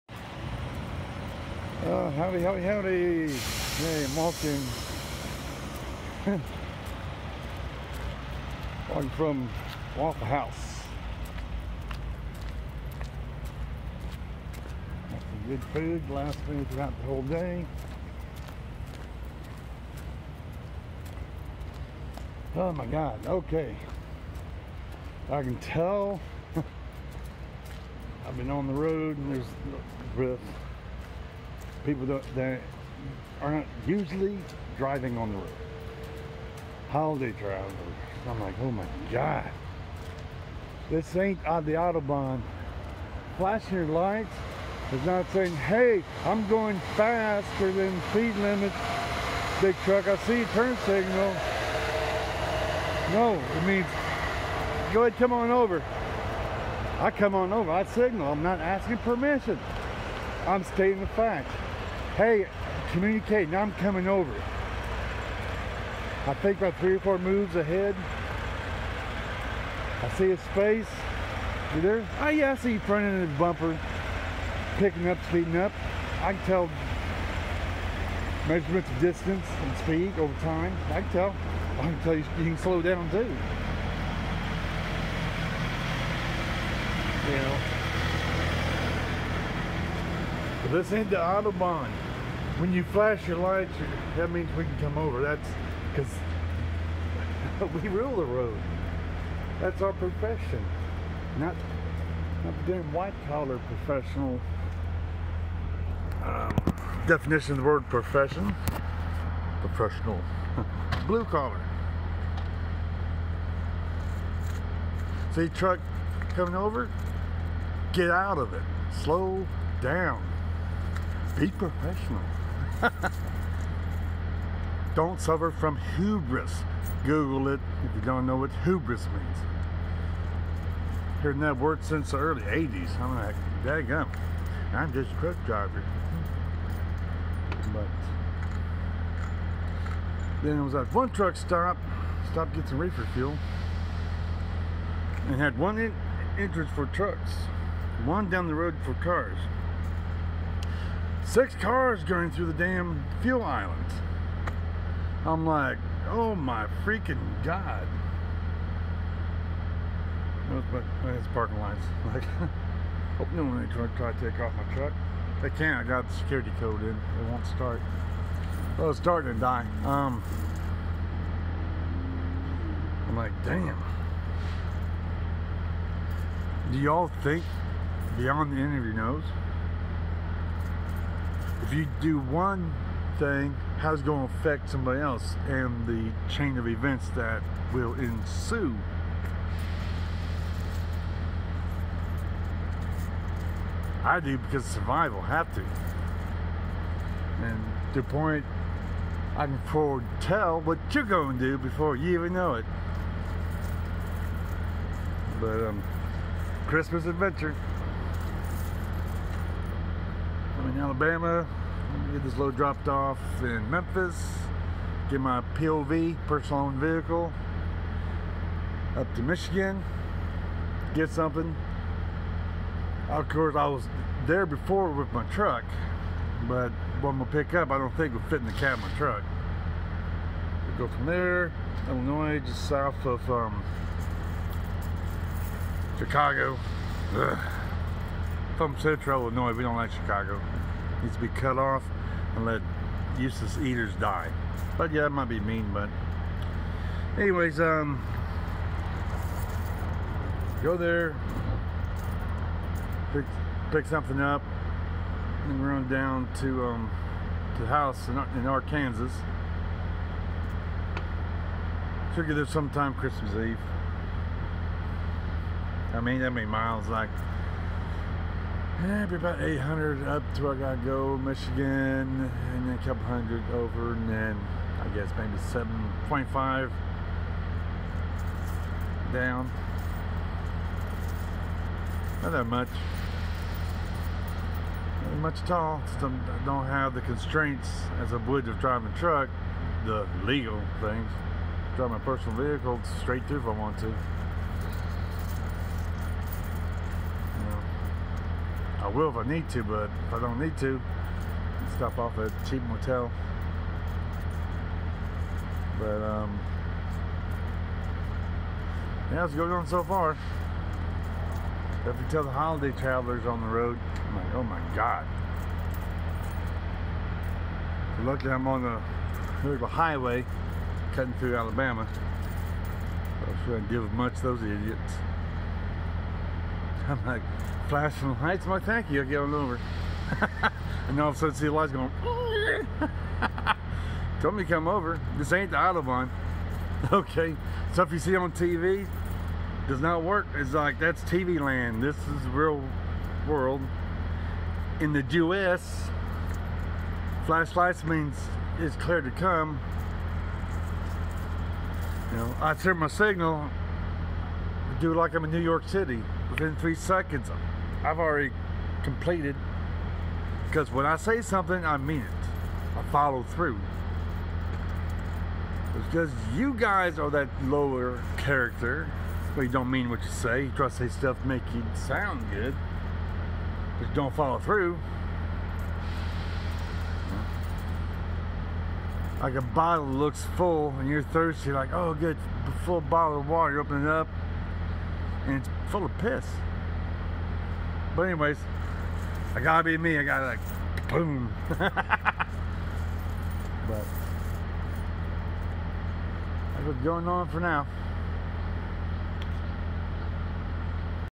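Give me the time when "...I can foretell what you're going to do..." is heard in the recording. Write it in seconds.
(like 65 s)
199 s.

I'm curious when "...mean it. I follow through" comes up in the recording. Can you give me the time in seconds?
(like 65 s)
361 s.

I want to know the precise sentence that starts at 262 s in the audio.
Should get there sometime Christmas Eve.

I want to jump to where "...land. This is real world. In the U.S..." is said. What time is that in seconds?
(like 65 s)
341 s.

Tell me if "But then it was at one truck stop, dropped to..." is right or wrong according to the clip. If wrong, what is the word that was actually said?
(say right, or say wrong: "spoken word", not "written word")
wrong: "stopped", not "dropped".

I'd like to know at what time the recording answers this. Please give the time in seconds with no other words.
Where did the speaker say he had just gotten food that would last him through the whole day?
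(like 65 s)
9 s.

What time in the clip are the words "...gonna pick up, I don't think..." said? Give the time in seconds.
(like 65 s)
227 s.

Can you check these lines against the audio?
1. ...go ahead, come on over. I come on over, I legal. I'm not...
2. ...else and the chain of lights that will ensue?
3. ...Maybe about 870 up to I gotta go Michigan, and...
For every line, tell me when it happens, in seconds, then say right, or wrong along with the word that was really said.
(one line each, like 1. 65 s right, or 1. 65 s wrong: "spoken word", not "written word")
1. 54 s wrong: "signal", not "legal"
2. 184 s wrong: "events", not "lights"
3. 268 s wrong: "800", not "870".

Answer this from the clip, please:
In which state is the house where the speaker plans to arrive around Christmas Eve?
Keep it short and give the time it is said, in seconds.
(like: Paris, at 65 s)
Arkansas, at 258 s.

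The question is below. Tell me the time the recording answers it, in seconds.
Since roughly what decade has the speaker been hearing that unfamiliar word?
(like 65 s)
132 s.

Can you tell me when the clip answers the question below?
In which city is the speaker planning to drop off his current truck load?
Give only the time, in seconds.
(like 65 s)
213 s.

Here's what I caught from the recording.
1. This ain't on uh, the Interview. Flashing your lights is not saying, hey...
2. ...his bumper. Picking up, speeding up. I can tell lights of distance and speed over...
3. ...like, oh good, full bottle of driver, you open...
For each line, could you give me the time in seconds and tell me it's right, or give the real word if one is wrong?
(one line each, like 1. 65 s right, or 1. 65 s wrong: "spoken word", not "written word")
1. 40 s wrong: "Autobahn", not "Interview"
2. 73 s wrong: "measurements", not "lights"
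3. 381 s wrong: "water", not "driver".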